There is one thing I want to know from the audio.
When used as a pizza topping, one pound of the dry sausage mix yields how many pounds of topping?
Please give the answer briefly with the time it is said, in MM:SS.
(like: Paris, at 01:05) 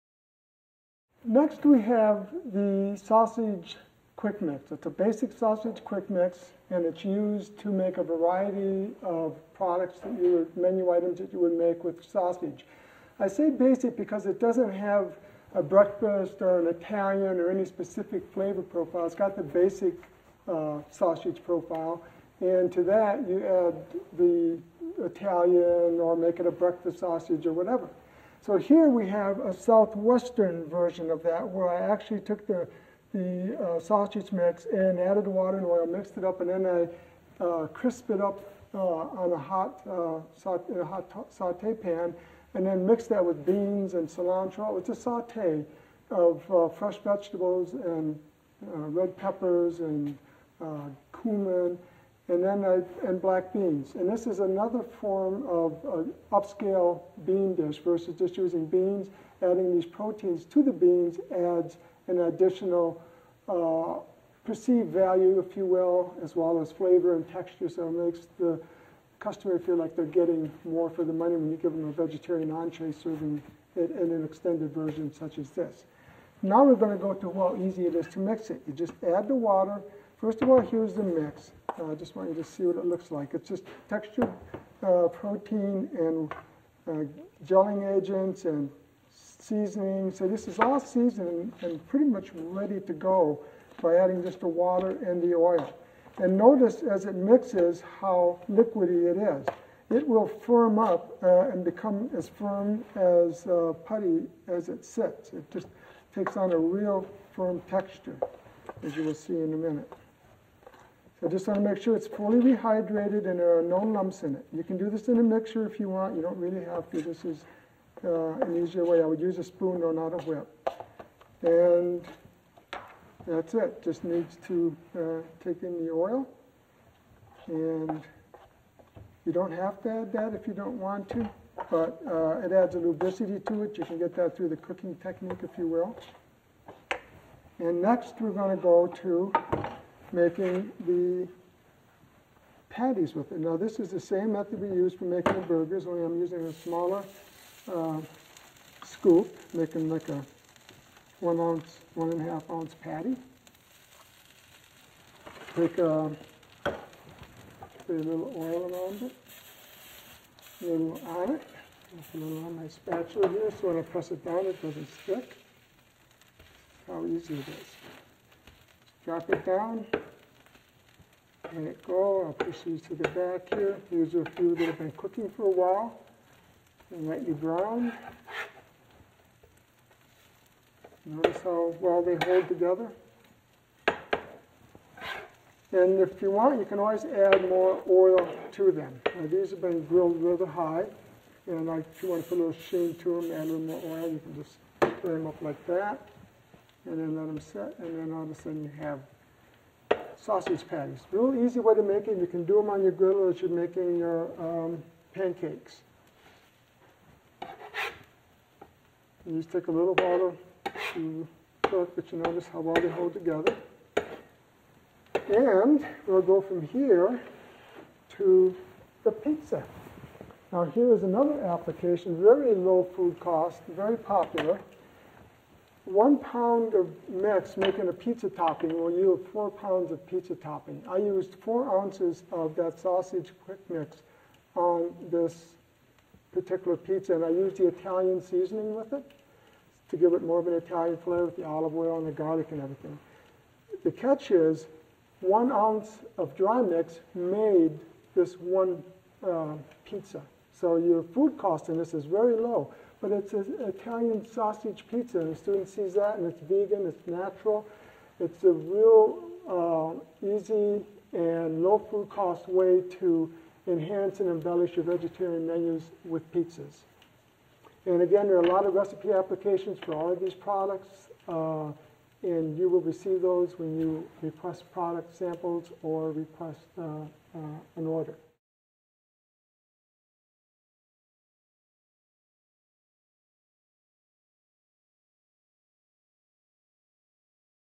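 4 pounds, at 03:49.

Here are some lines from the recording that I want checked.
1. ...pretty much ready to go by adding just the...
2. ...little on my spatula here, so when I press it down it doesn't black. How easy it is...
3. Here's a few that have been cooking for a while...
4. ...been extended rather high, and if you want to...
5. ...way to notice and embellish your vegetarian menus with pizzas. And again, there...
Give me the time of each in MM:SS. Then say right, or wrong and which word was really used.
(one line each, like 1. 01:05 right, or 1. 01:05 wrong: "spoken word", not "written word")
1. 01:31 right
2. 02:42 wrong: "stick", not "black"
3. 02:53 right
4. 03:09 wrong: "grilled", not "extended"
5. 04:22 wrong: "enhance", not "notice".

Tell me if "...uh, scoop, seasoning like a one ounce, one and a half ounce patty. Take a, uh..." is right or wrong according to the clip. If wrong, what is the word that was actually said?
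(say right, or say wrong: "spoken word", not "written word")
wrong: "making", not "seasoning".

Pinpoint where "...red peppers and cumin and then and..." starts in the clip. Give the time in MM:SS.
00:48.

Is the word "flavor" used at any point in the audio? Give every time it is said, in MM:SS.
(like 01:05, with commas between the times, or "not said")
00:18, 01:06, 04:00.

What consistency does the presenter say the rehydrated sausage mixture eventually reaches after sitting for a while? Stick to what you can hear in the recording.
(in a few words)
putty.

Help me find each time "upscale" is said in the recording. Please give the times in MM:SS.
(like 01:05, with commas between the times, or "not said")
00:56.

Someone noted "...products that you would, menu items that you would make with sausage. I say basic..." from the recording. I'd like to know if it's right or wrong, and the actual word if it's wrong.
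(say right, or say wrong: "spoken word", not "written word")
right.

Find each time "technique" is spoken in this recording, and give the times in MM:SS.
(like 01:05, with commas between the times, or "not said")
02:14.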